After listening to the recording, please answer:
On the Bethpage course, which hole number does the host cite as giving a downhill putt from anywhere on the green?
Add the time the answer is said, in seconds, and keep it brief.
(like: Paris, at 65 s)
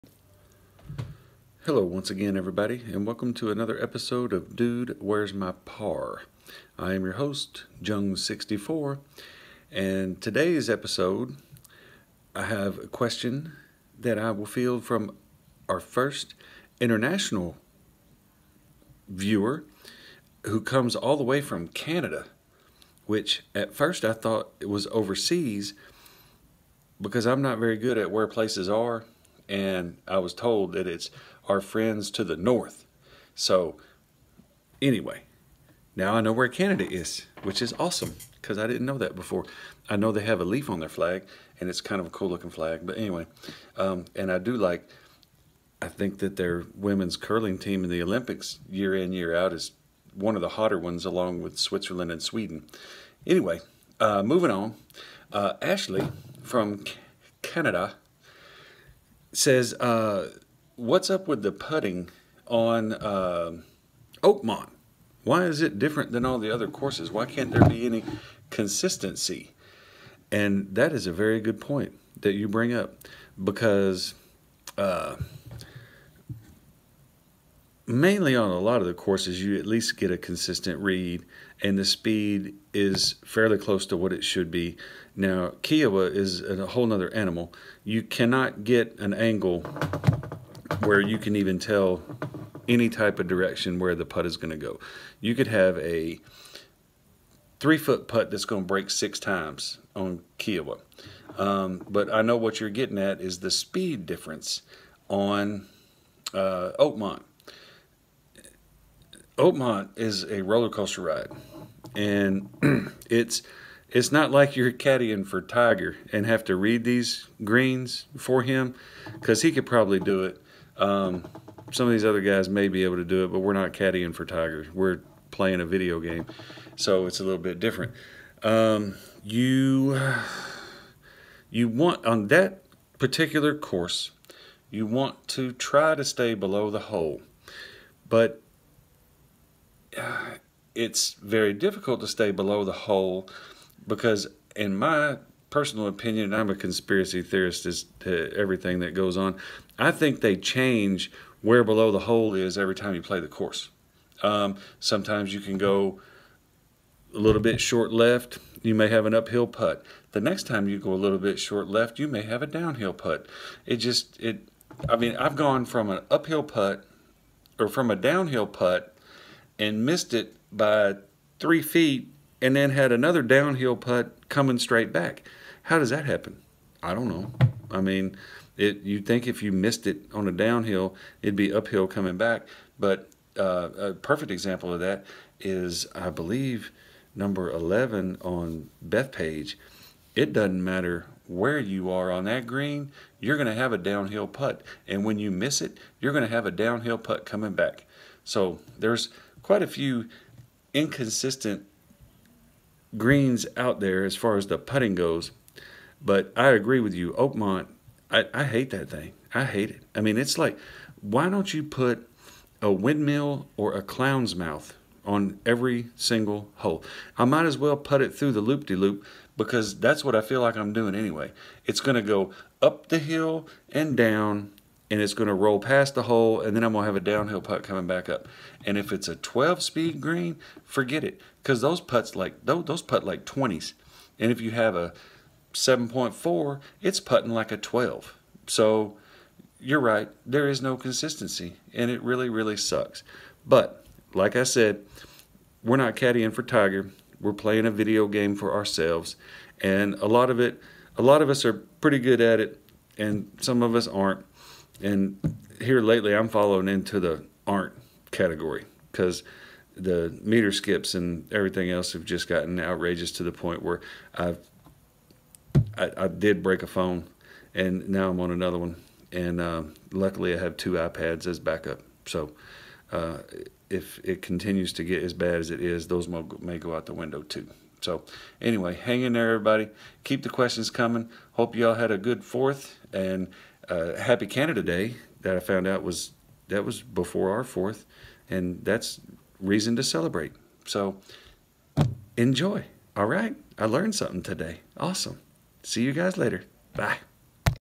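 11, at 187 s.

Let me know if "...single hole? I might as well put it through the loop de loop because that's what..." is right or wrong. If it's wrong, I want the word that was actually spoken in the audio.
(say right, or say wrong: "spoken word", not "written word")
right.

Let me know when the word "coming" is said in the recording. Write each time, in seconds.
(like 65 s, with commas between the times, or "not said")
174 s, 181 s, 197 s, 227 s, 280 s.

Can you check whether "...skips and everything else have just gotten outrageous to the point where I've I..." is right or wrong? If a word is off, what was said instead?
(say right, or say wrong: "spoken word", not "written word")
right.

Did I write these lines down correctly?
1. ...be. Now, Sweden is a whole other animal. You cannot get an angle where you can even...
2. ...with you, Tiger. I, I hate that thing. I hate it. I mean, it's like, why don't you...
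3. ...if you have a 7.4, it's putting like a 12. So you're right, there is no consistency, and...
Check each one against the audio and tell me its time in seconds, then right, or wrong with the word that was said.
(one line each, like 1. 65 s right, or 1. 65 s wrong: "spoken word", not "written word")
1. 84 s wrong: "Kiawah", not "Sweden"
2. 206 s wrong: "Oakmont", not "Tiger"
3. 234 s right.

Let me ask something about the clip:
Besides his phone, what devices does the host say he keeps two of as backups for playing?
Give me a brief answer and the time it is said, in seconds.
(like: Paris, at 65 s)
iPads, at 270 s.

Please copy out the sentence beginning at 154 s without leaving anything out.
Um, sometimes you can go a little bit short left, you may have an uphill putt.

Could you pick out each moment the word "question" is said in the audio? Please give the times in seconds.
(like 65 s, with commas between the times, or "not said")
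12 s, 280 s.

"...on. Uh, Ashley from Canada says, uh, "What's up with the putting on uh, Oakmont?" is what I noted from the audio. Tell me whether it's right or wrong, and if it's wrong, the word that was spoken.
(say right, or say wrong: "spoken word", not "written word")
right.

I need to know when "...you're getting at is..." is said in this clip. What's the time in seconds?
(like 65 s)
102 s.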